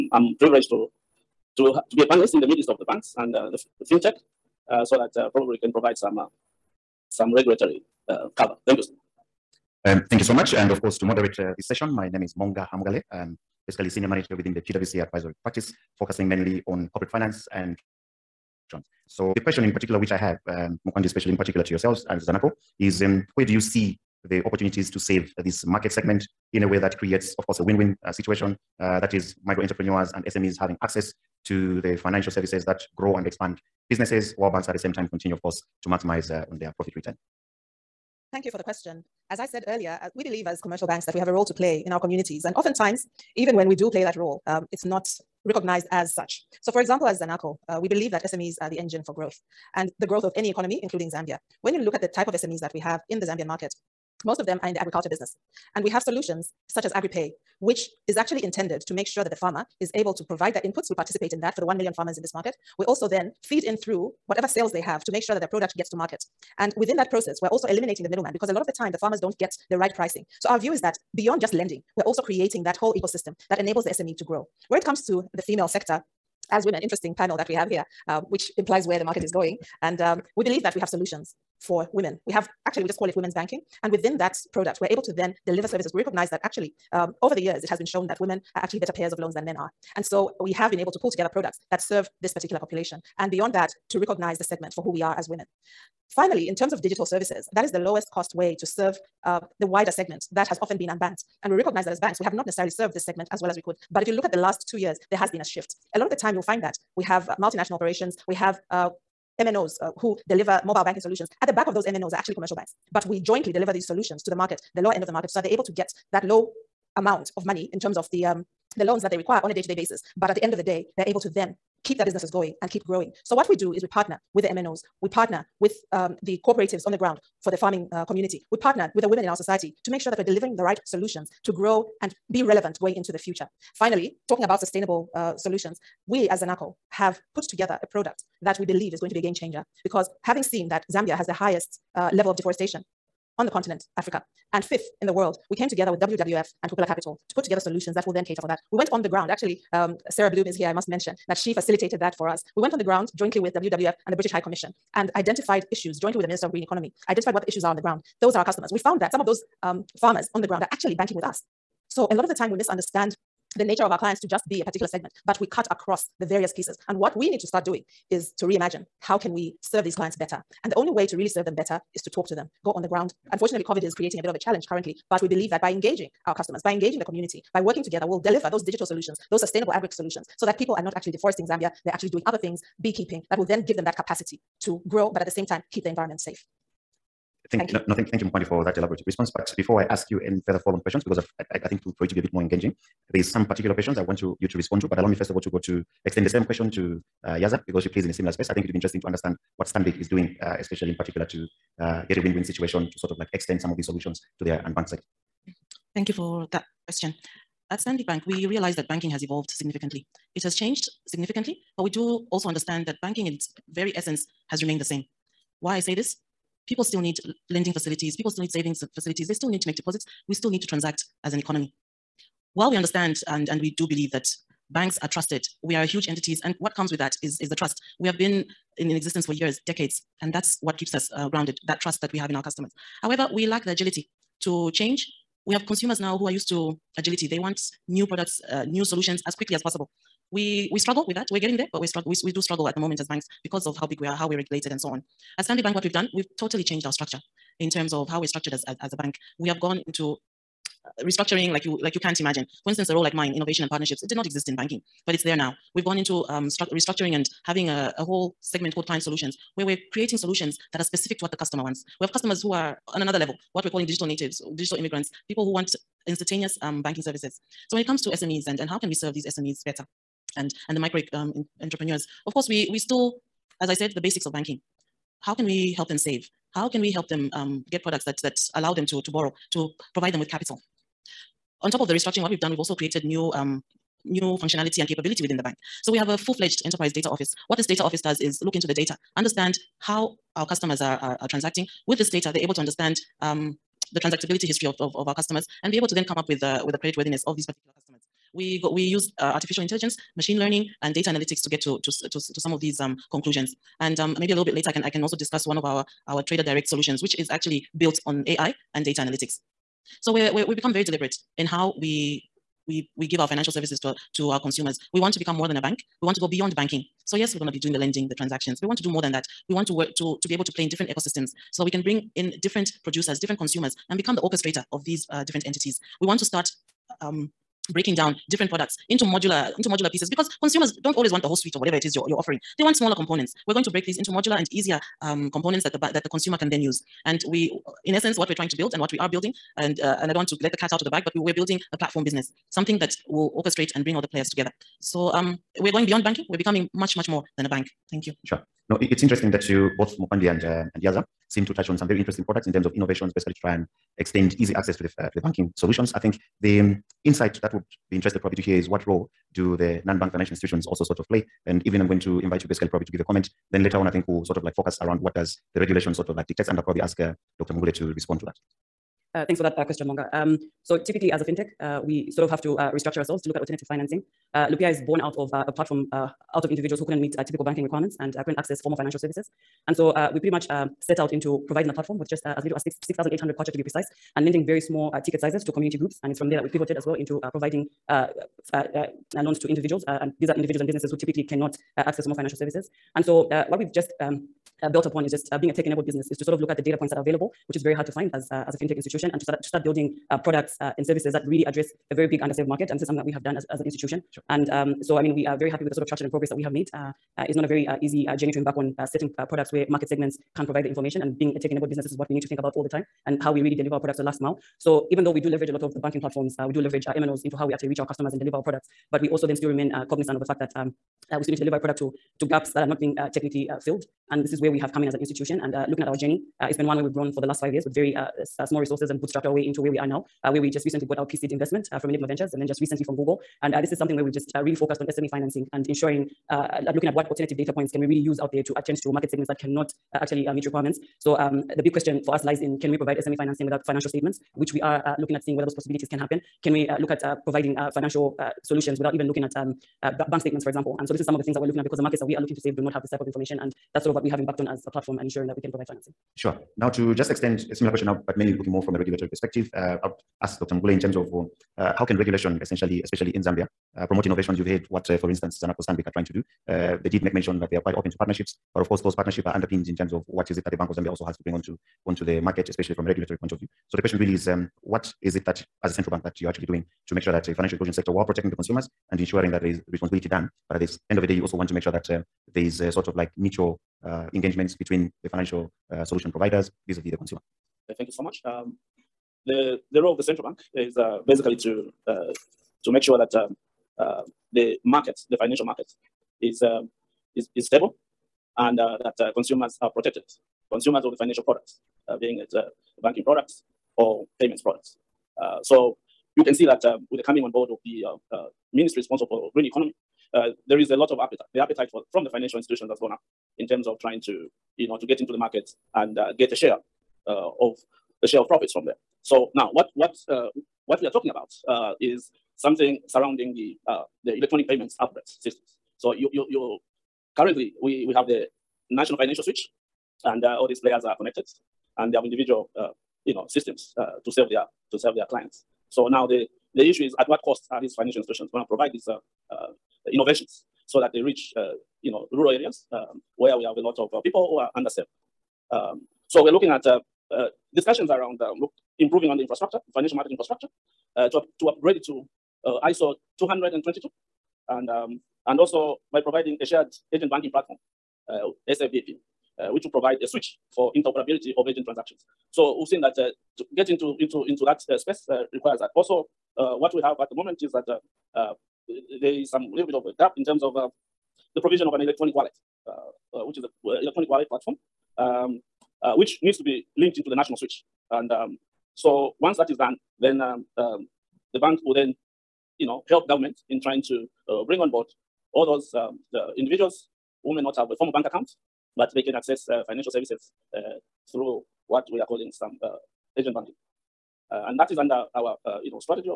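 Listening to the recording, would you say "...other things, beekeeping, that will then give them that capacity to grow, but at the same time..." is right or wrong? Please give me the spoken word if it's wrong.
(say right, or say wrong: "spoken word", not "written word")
right.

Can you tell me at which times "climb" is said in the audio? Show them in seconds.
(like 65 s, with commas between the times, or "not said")
not said.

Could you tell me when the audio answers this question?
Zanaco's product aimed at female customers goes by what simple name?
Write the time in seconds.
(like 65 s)
83 s.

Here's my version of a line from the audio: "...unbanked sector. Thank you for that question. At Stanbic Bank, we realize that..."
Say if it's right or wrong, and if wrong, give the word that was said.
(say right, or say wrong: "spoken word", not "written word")
right.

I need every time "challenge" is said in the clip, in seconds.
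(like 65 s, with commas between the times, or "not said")
174 s.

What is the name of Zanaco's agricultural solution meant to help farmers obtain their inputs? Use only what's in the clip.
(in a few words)
AgriPay.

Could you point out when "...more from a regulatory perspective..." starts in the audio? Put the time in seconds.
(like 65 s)
458 s.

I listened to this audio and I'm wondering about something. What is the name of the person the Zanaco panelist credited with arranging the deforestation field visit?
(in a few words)
Sarah Bloom.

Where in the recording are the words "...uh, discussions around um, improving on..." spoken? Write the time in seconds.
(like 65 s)
547 s.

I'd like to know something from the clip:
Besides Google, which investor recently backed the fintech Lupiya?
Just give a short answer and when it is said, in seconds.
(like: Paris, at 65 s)
Enygma Ventures, at 431 s.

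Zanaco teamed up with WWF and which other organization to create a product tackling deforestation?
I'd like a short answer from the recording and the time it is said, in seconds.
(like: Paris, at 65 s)
Kukula Capital, at 146 s.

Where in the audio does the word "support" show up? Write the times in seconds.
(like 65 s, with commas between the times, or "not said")
not said.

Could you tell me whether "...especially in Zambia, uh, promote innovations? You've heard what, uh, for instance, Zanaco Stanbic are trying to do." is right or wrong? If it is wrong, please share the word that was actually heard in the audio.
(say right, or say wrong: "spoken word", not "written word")
right.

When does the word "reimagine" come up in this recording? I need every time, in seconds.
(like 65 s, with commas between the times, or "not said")
168 s.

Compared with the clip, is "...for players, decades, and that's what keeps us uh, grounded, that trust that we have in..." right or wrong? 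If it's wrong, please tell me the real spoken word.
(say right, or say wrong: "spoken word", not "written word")
wrong: "years", not "players".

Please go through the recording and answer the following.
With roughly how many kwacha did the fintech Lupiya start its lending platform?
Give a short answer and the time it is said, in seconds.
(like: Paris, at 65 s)
6,800, at 382 s.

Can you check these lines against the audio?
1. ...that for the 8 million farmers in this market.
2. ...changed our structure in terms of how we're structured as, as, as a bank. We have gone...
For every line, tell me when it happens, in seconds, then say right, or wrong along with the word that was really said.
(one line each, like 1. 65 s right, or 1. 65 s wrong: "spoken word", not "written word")
1. 61 s wrong: "1", not "8"
2. 246 s right.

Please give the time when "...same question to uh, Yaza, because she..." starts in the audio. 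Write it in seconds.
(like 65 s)
196 s.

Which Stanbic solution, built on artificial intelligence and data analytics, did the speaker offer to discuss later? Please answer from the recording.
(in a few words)
Trader Direct.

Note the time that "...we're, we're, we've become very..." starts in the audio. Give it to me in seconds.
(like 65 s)
310 s.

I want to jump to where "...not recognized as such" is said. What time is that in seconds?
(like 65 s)
44 s.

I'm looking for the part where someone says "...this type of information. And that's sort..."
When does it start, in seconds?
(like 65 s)
452 s.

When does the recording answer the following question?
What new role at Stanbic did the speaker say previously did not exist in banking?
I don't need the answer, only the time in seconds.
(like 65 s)
253 s.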